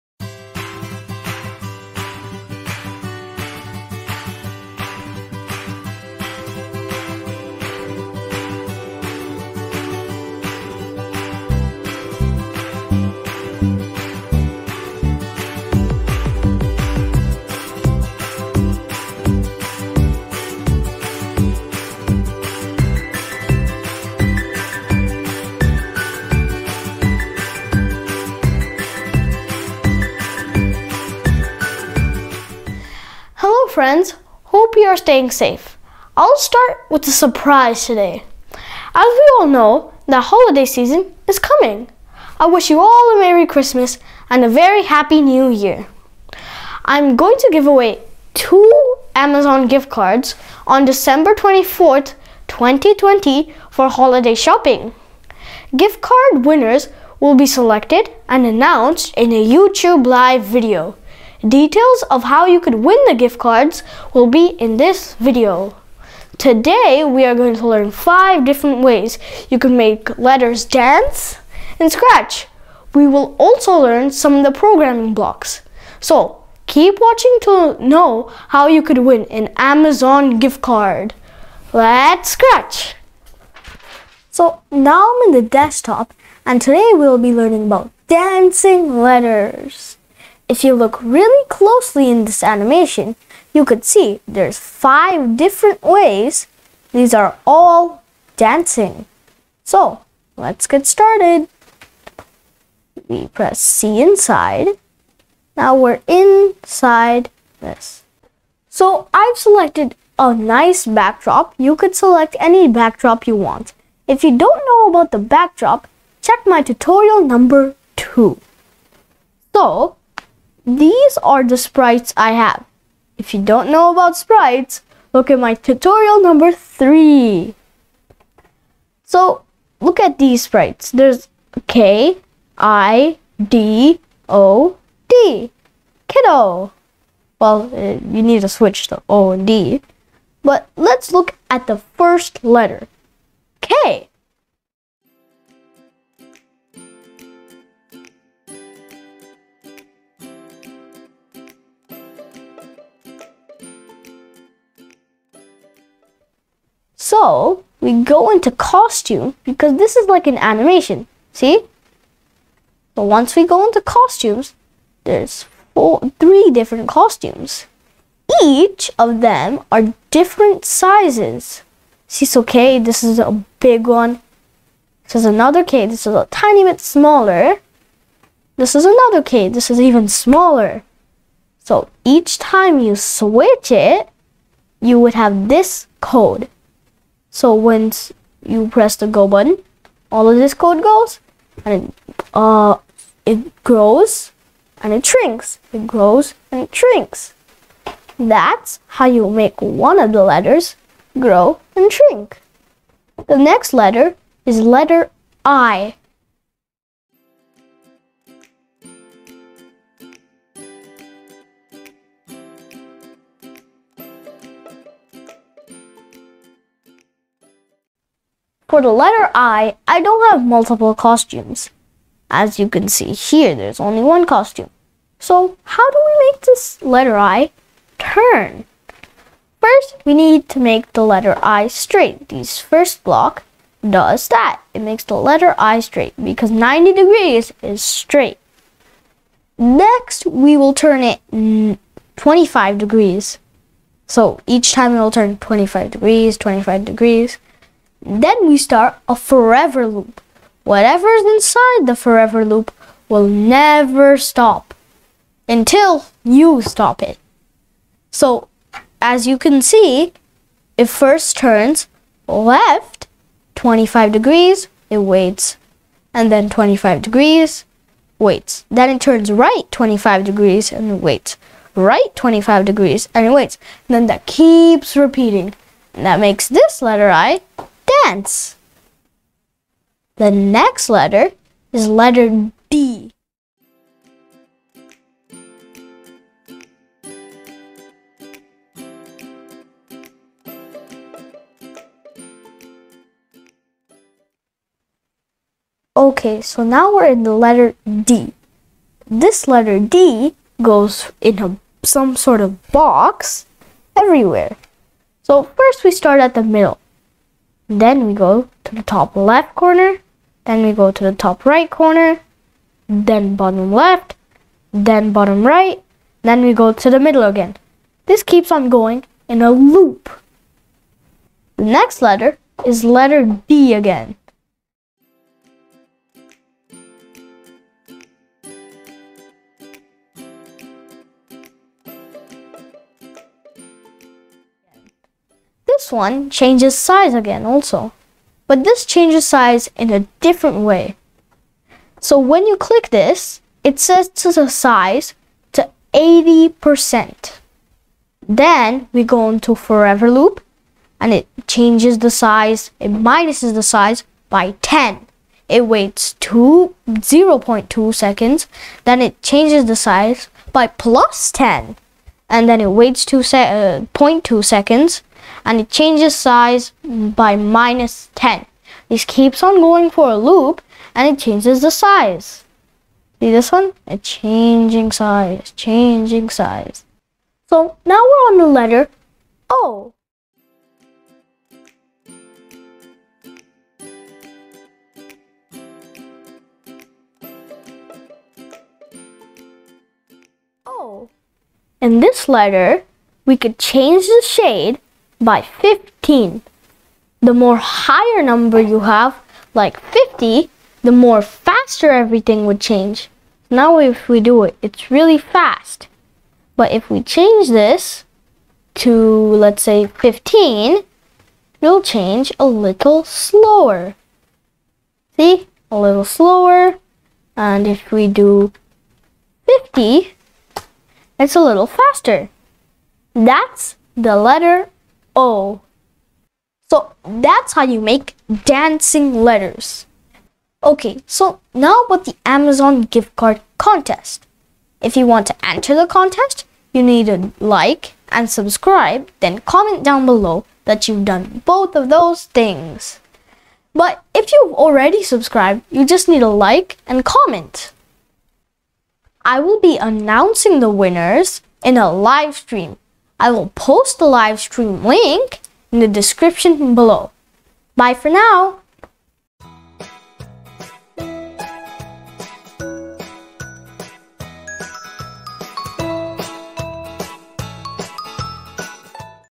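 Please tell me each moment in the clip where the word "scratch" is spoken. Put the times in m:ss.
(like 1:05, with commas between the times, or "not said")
1:11, 1:22.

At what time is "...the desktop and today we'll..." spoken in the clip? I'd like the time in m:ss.
1:25.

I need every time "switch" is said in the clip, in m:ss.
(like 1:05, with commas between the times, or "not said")
2:18, 3:02.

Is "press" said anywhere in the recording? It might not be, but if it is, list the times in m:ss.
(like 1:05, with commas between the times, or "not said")
1:43, 3:08.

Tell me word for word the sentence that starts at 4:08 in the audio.
Then we start a forever loop.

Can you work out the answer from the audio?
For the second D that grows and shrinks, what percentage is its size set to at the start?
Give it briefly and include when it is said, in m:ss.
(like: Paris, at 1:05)
80%, at 5:45.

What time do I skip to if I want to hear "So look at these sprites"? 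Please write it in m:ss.
2:09.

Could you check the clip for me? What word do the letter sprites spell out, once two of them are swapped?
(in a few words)
Kiddo.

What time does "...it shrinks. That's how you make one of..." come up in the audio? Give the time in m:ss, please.
3:16.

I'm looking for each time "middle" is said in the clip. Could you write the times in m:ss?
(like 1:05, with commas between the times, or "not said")
5:06, 5:16.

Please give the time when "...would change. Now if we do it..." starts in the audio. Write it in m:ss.
6:42.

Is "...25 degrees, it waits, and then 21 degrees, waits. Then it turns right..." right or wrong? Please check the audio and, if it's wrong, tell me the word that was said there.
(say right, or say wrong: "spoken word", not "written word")
wrong: "25", not "21".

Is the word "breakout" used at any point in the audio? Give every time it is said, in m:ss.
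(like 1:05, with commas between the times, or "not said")
not said.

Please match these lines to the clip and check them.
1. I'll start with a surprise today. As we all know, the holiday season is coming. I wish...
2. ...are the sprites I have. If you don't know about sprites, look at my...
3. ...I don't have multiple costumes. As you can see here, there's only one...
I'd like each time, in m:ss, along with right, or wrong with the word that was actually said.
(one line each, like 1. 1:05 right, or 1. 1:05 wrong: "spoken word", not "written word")
1. 0:36 right
2. 2:01 right
3. 3:39 right.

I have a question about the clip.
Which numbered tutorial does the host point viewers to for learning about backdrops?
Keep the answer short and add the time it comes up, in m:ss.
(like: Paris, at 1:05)
2, at 1:57.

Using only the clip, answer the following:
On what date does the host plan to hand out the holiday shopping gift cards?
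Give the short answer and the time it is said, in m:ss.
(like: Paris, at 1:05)
December 24th, 2020, at 0:50.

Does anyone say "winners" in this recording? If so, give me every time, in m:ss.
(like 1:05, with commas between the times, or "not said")
0:56, 7:30.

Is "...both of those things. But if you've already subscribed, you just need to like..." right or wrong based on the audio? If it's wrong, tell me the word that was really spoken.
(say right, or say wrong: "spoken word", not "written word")
right.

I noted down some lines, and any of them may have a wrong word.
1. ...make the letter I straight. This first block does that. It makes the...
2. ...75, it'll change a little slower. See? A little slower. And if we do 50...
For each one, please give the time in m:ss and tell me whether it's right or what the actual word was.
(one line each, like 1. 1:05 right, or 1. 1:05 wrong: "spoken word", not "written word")
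1. 3:50 right
2. 6:49 wrong: "15", not "75".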